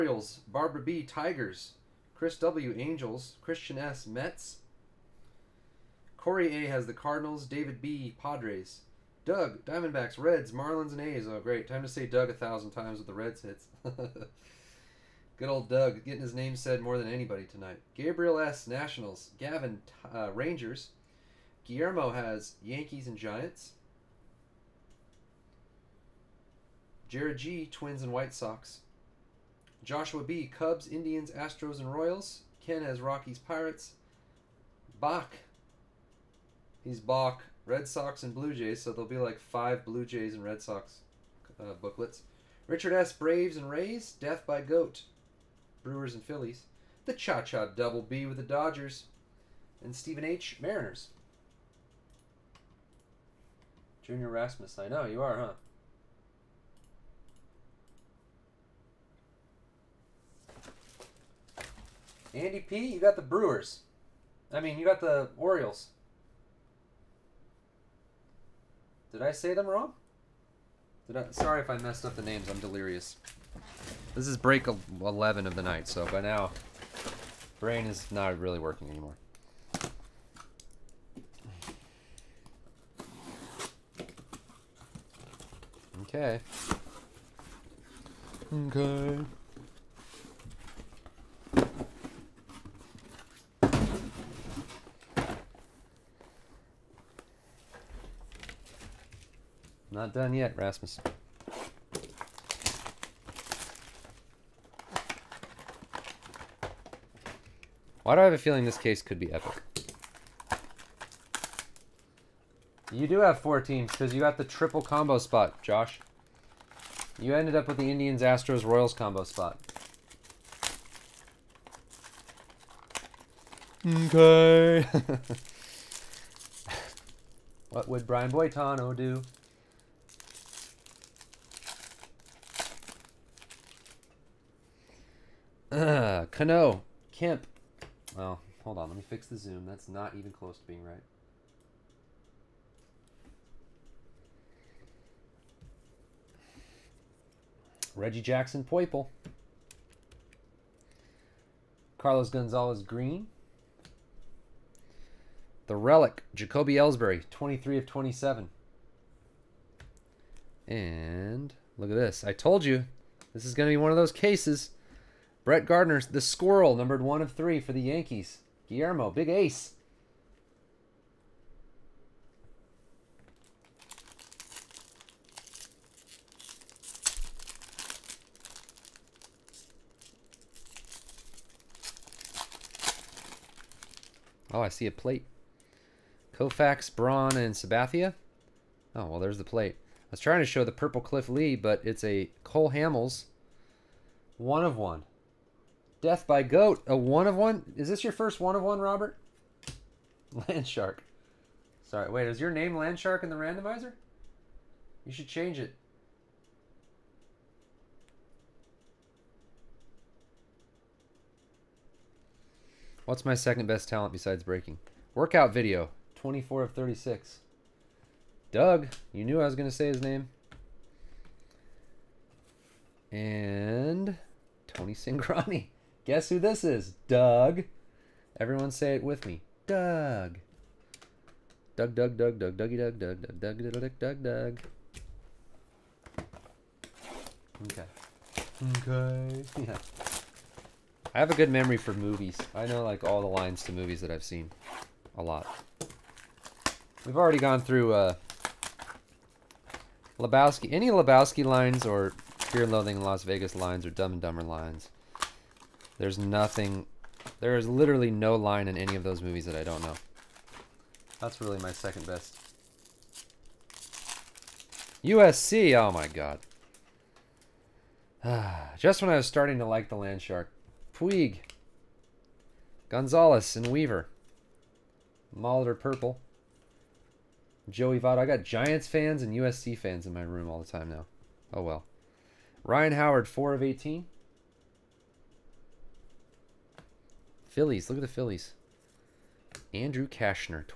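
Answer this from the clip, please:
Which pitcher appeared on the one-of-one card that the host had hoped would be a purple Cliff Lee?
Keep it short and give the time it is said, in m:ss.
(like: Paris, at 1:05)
Cole Hamels, at 3:12.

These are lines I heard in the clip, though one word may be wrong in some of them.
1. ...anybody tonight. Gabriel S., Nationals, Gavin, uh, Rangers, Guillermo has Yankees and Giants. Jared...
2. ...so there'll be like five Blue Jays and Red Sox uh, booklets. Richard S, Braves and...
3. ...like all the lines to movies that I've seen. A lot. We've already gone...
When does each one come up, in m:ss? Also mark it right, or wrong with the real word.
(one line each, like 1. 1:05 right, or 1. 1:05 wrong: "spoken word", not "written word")
1. 0:17 right
2. 0:38 right
3. 4:02 right.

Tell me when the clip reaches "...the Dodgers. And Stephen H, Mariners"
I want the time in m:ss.
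0:48.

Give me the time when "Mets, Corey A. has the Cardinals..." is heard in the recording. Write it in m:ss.
0:04.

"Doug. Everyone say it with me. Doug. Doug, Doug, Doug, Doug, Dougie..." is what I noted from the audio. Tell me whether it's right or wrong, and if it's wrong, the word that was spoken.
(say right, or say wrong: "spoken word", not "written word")
right.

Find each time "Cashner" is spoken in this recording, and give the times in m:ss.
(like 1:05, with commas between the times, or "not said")
4:50.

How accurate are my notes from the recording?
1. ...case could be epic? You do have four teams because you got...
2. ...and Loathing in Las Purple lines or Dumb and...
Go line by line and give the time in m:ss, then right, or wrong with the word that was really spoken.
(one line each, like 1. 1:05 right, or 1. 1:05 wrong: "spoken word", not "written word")
1. 1:48 right
2. 4:12 wrong: "Vegas", not "Purple".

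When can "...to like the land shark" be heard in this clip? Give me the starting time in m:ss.
4:29.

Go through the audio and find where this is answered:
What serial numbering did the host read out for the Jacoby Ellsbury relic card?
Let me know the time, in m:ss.
2:37.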